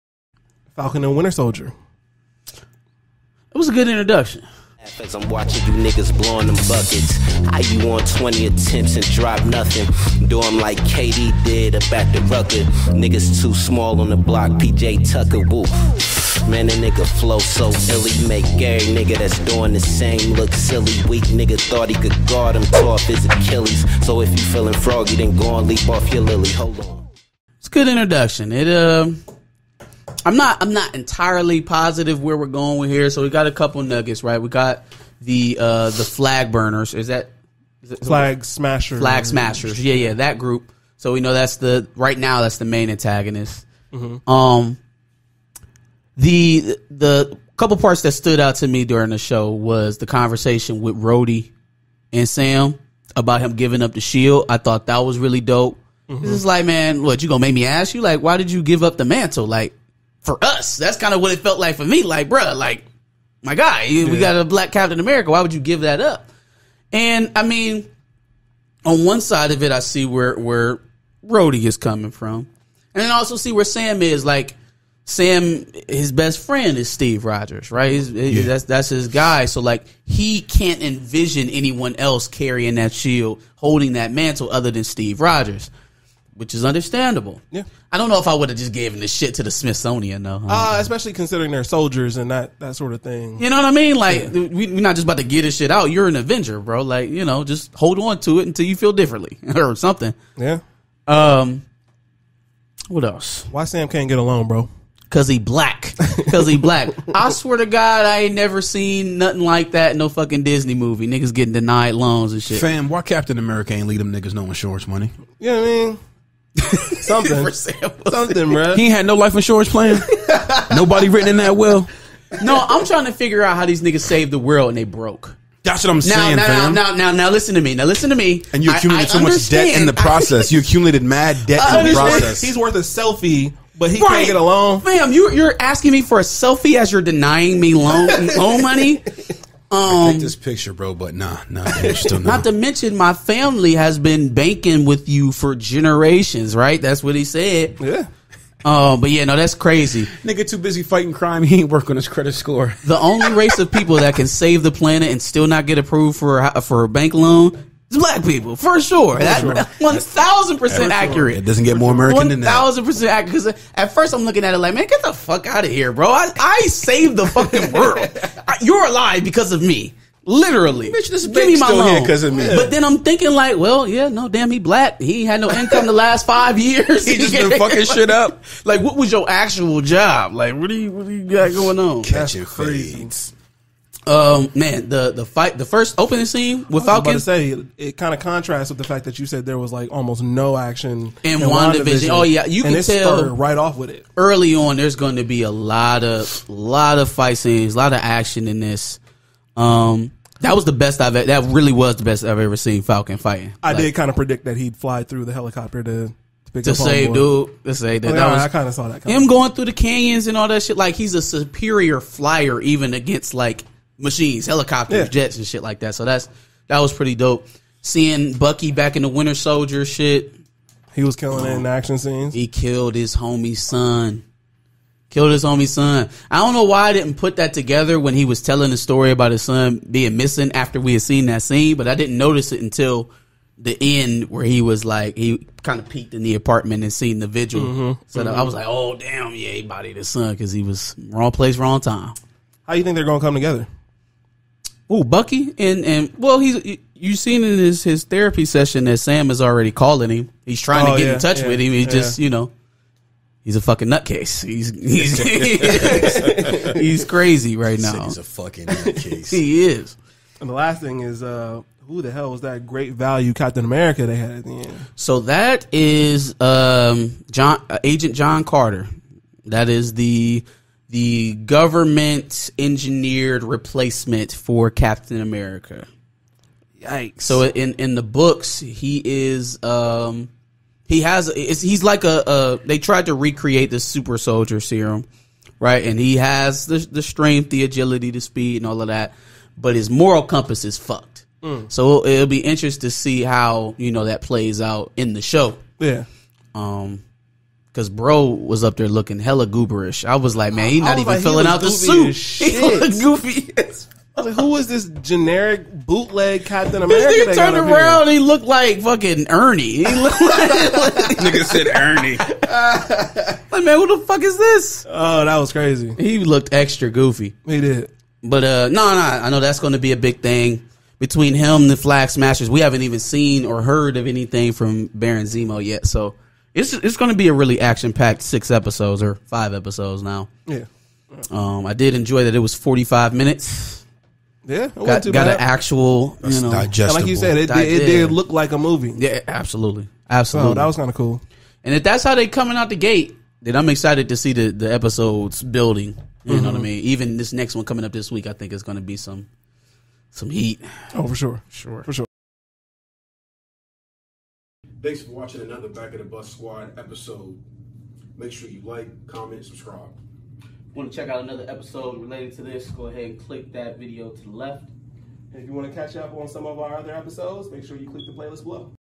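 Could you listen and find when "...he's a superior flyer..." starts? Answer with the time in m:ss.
3:30.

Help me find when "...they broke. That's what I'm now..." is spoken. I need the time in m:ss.
2:04.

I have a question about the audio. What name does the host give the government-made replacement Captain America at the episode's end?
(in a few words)
John Carter.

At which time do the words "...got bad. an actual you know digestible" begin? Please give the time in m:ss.
5:35.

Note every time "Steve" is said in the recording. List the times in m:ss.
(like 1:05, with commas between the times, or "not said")
1:16, 1:24.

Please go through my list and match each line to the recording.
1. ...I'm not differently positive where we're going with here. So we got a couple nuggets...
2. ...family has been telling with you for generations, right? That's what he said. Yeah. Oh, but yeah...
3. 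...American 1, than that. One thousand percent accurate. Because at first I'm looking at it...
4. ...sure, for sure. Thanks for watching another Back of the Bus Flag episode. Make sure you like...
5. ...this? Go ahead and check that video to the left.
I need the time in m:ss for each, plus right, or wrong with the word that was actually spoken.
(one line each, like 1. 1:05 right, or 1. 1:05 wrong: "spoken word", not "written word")
1. 0:30 wrong: "entirely", not "differently"
2. 2:23 wrong: "banking", not "telling"
3. 2:41 right
4. 5:51 wrong: "Squad", not "Flag"
5. 6:02 wrong: "click", not "check".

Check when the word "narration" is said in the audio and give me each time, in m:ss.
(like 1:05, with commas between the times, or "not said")
not said.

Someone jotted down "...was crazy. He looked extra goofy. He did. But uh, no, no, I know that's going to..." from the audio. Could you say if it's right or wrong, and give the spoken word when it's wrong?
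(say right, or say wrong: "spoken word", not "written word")
right.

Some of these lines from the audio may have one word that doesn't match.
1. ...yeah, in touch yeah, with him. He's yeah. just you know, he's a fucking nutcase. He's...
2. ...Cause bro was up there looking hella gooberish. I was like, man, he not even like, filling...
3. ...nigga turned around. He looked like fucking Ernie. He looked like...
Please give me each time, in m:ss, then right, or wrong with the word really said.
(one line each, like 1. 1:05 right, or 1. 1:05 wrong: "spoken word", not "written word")
1. 4:11 right
2. 4:57 right
3. 5:07 right.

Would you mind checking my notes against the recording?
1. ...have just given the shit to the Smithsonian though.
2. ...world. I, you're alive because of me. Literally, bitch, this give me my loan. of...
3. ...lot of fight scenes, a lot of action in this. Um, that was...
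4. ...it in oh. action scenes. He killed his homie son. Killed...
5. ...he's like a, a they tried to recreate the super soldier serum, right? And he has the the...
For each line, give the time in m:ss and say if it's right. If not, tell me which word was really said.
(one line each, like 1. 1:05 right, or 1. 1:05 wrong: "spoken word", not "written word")
1. 1:28 right
2. 2:47 right
3. 3:16 right
4. 3:41 right
5. 4:41 right.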